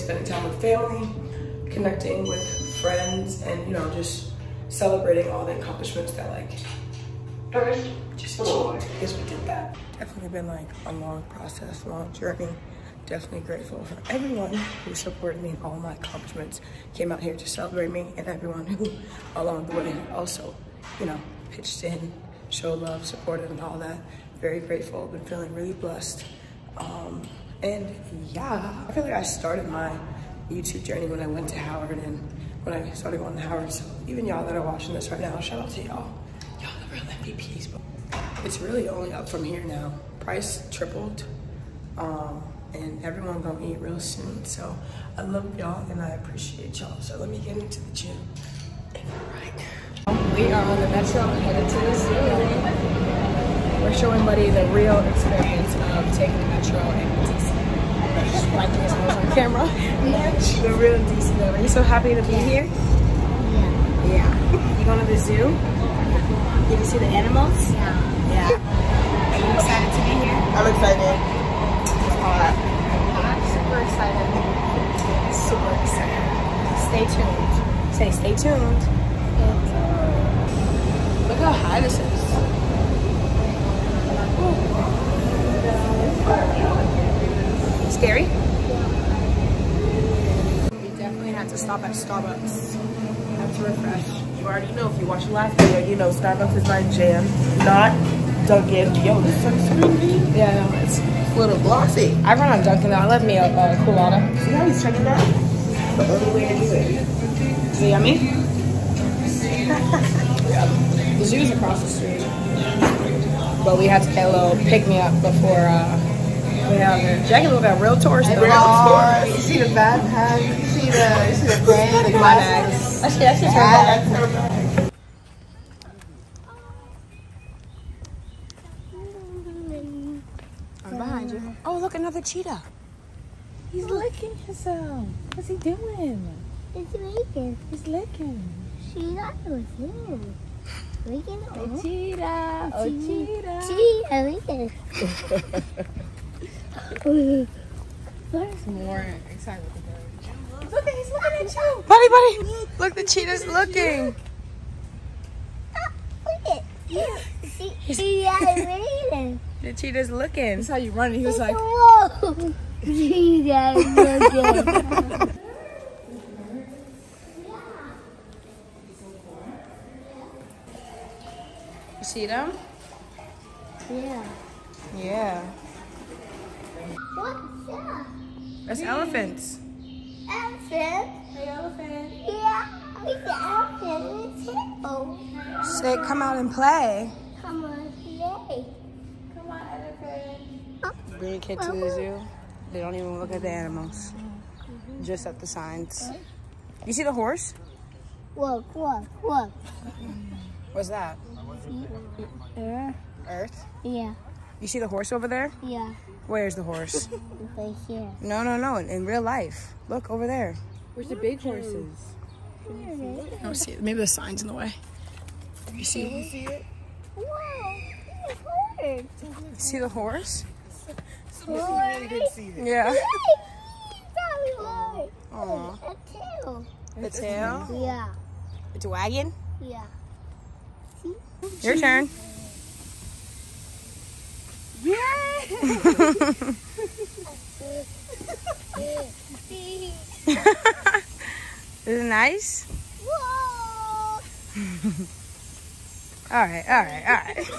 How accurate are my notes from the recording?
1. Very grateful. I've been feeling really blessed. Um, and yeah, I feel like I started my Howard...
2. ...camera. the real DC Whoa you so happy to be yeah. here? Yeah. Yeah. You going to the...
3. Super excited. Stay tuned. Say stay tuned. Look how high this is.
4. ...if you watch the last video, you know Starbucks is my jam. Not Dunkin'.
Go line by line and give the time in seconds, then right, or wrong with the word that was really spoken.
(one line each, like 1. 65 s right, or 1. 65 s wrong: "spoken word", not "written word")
1. 24 s wrong: "YouTube", not "Howard"
2. 59 s wrong: "Are", not "Whoa"
3. 76 s right
4. 94 s right.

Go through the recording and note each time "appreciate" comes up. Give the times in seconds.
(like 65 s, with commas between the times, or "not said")
46 s.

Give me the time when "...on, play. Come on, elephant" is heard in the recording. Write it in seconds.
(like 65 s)
187 s.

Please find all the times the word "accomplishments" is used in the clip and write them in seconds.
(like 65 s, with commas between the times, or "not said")
5 s, 15 s.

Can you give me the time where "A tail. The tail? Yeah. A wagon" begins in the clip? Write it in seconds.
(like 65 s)
225 s.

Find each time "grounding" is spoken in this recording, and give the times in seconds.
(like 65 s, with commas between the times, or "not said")
not said.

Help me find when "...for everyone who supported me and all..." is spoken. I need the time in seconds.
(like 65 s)
13 s.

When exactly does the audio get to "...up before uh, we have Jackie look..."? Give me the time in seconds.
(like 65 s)
114 s.